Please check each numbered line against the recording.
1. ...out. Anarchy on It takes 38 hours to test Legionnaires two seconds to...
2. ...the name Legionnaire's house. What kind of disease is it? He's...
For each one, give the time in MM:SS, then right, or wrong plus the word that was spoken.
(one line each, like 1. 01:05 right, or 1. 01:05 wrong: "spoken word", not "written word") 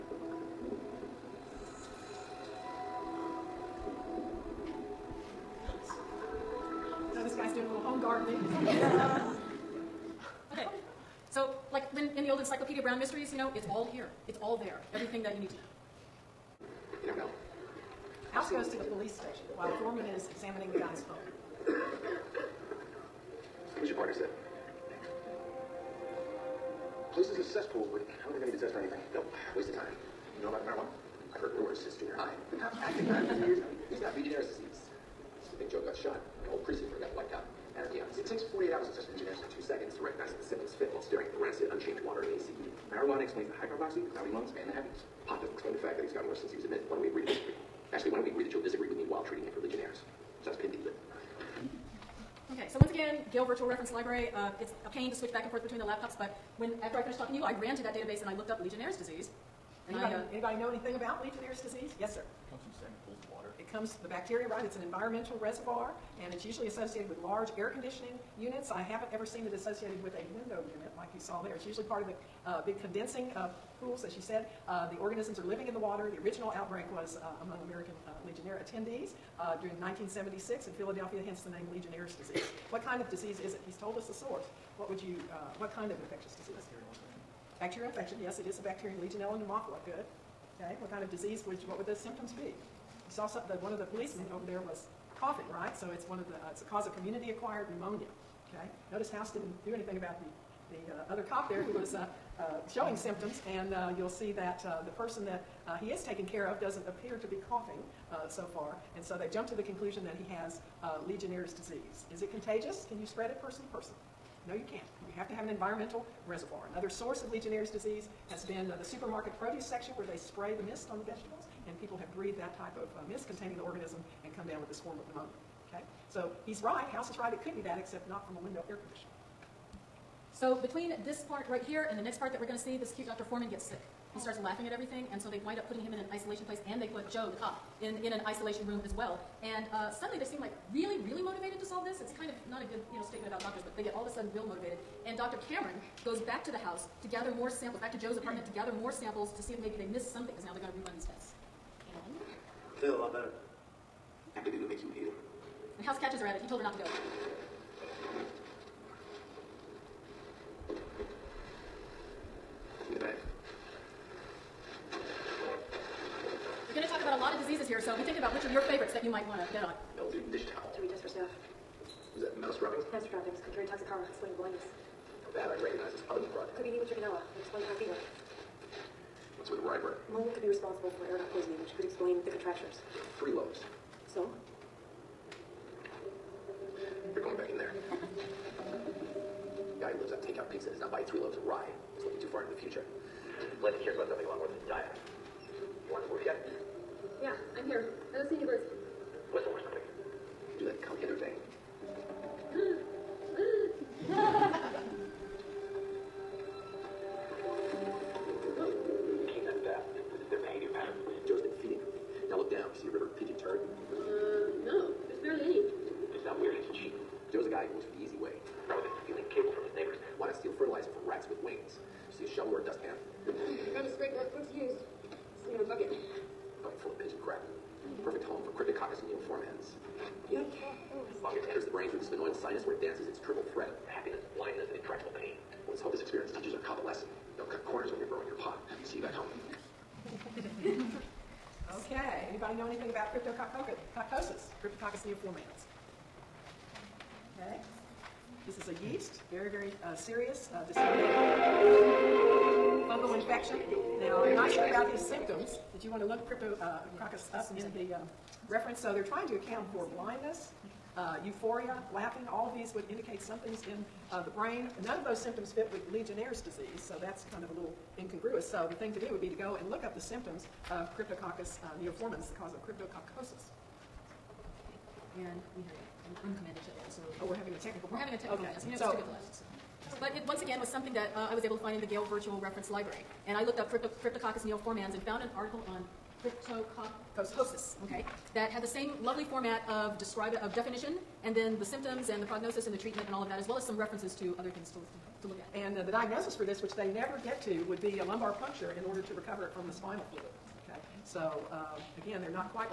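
1. 00:37 wrong: "48", not "38"
2. 01:21 wrong: "disease", not "house".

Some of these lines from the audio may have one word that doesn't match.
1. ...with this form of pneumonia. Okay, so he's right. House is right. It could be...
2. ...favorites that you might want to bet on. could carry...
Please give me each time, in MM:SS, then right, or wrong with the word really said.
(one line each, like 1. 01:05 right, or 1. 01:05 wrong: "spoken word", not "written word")
1. 02:04 right
2. 02:48 right.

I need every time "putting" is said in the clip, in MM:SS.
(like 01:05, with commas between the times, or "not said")
02:15.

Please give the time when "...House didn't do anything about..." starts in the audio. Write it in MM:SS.
01:39.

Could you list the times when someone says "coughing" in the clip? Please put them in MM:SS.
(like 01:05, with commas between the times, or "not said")
01:35, 01:47.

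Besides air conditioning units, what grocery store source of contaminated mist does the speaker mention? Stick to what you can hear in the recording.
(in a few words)
Supermarket produce section.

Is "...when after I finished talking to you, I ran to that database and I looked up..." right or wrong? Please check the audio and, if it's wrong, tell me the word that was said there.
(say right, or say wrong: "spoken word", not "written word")
right.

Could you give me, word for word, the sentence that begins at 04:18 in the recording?
So they're trying to account for blindness, uh, euphoria, laughing.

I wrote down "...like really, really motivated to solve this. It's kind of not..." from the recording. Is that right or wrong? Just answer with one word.
right.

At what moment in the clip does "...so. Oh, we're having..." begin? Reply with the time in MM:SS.
04:36.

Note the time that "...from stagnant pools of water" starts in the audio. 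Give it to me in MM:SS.
01:02.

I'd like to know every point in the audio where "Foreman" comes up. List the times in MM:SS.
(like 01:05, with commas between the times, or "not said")
00:19, 02:13.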